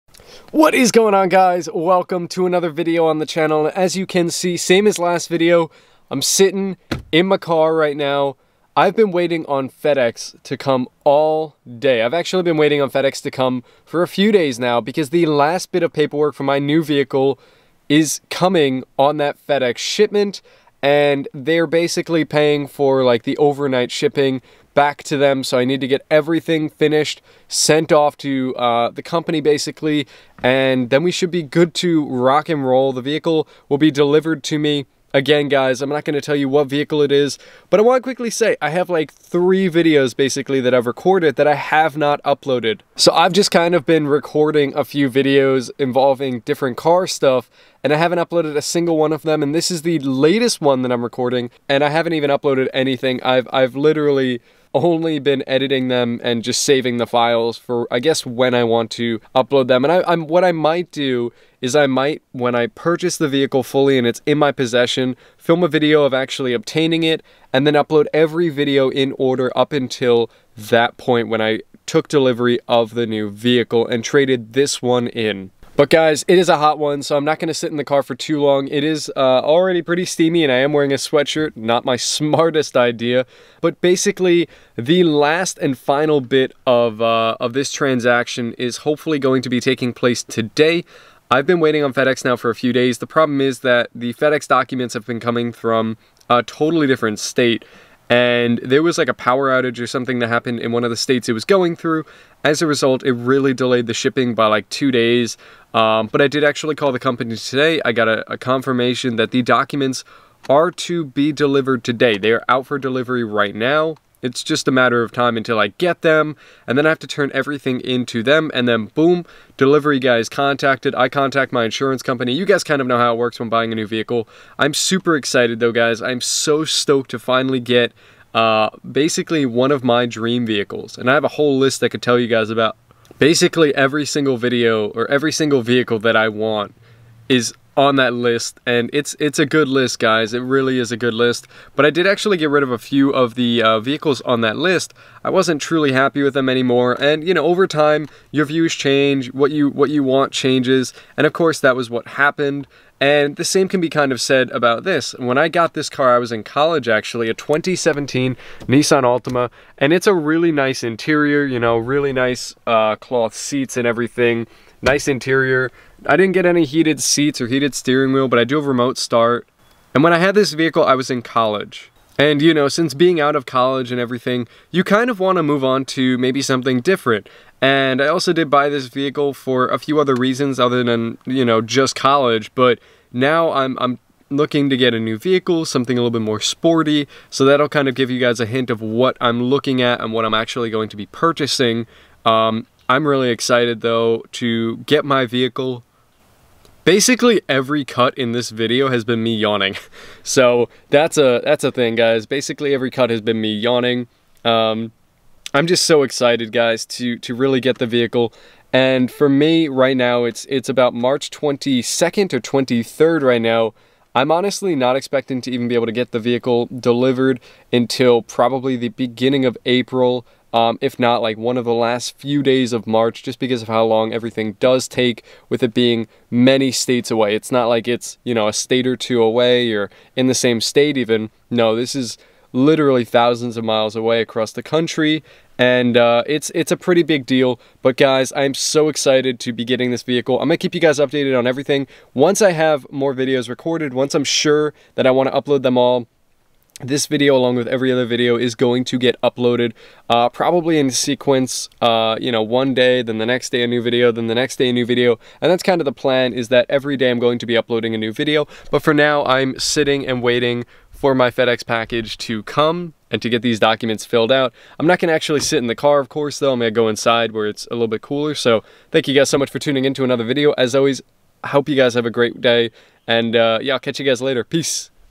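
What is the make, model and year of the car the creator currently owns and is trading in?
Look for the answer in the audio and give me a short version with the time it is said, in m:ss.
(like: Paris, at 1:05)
2017 Nissan Altima, at 2:37.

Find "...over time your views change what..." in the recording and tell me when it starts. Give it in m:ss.
2:27.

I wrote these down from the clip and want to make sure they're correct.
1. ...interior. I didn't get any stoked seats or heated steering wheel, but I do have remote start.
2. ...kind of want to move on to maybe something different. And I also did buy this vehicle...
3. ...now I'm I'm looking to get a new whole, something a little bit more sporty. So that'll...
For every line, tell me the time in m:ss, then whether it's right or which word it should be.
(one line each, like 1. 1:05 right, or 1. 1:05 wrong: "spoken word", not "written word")
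1. 2:45 wrong: "heated", not "stoked"
2. 2:54 right
3. 3:03 wrong: "vehicle", not "whole".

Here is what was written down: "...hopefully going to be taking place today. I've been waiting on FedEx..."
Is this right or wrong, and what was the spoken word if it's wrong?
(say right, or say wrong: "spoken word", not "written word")
right.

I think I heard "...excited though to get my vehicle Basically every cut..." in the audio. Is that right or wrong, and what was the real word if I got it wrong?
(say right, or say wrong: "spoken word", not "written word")
right.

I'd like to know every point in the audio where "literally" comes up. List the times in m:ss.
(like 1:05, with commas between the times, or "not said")
0:53, 3:52.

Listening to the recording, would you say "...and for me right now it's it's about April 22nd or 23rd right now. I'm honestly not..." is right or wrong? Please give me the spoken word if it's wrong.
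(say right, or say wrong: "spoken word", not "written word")
wrong: "March", not "April".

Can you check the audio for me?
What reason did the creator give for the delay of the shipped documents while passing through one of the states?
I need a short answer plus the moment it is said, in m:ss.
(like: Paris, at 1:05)
Power outage, at 1:39.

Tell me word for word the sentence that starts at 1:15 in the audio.
But guys, it is a hot one, so I'm not gonna sit in the car for too long.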